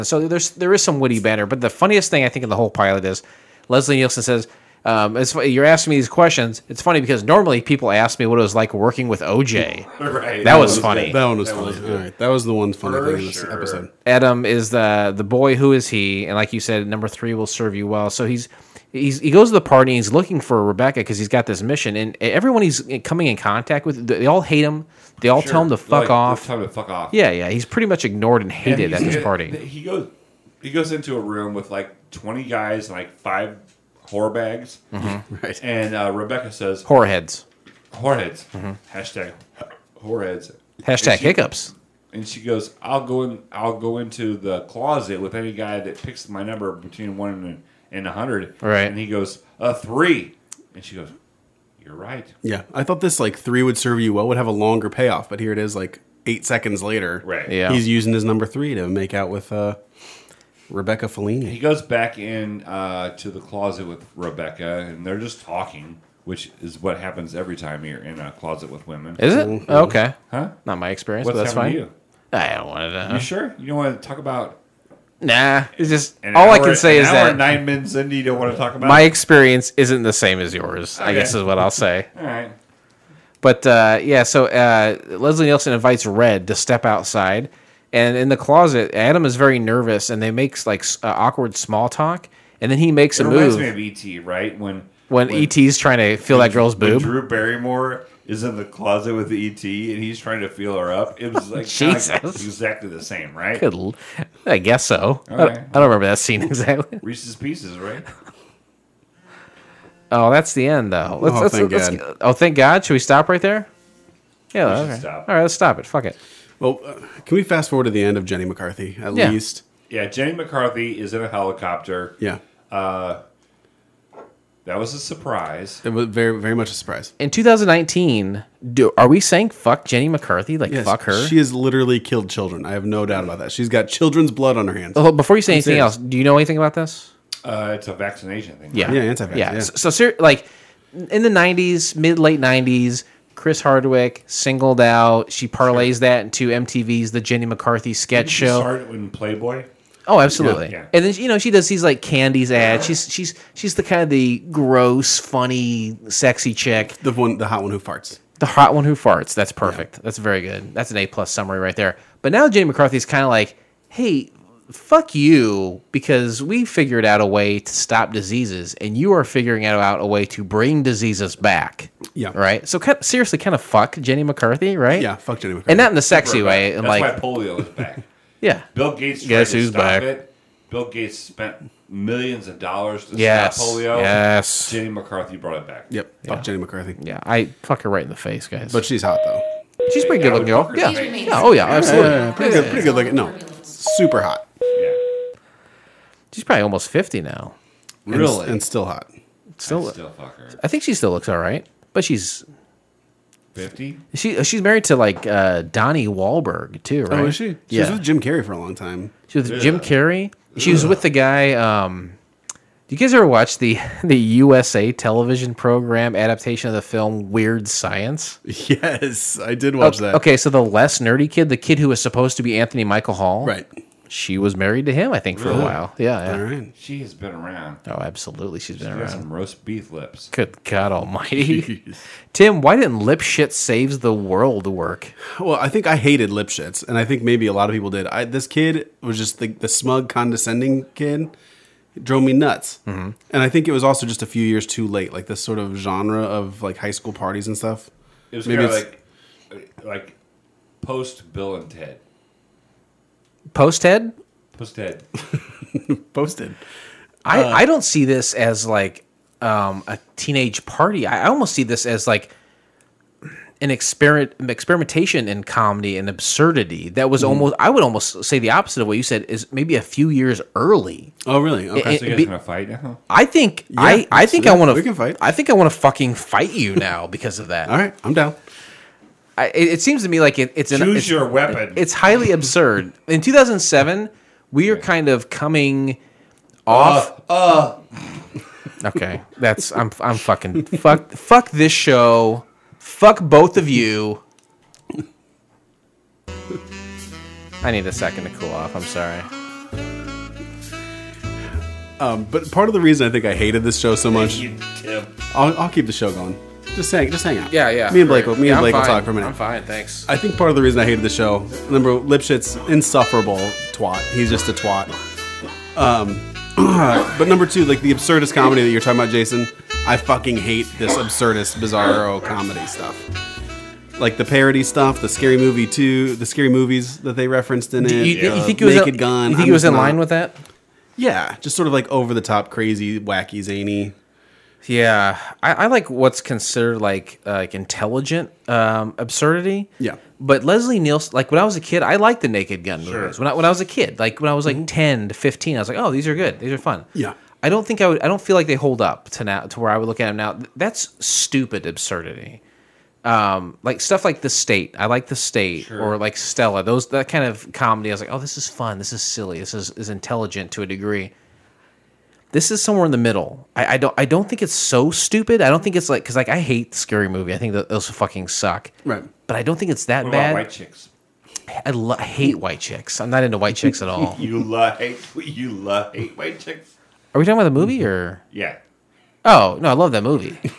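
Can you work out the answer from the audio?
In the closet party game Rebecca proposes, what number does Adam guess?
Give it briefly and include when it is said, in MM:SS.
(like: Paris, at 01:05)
3, at 00:49.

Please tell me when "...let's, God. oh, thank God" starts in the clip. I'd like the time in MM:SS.
01:51.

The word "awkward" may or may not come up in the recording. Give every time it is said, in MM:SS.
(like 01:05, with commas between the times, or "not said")
01:31.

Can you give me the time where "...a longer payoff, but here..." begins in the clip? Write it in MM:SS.
00:54.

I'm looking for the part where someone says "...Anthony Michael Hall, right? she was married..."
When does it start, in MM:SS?
03:42.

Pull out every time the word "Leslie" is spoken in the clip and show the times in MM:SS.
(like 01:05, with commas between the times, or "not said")
00:03, 01:25, 05:40.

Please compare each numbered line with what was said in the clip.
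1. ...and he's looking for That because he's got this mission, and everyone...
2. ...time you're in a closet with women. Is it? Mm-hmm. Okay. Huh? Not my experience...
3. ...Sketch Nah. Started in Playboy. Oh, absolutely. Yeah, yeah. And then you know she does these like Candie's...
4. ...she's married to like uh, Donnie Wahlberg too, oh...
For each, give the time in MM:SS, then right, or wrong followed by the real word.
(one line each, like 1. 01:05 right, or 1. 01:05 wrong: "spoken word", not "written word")
1. 00:19 wrong: "Rebecca", not "That"
2. 01:07 right
3. 02:27 wrong: "Show", not "Nah"
4. 03:24 right.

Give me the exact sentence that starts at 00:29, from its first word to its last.
He goes, he goes into a room with like twenty guys and like five whore bags, mm-hmm.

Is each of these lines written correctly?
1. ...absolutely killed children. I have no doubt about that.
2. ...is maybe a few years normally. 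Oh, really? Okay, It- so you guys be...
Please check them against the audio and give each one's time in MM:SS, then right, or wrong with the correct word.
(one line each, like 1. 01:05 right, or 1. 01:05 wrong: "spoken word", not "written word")
1. 02:11 wrong: "literally", not "absolutely"
2. 04:29 wrong: "early", not "normally".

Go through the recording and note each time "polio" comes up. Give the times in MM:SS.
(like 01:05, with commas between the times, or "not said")
02:57, 03:03.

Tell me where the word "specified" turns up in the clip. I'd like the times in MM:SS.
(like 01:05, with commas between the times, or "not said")
not said.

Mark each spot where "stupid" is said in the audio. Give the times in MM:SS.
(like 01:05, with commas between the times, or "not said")
05:51, 06:04.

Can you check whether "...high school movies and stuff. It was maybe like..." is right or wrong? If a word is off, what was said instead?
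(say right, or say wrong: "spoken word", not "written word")
wrong: "parties", not "movies".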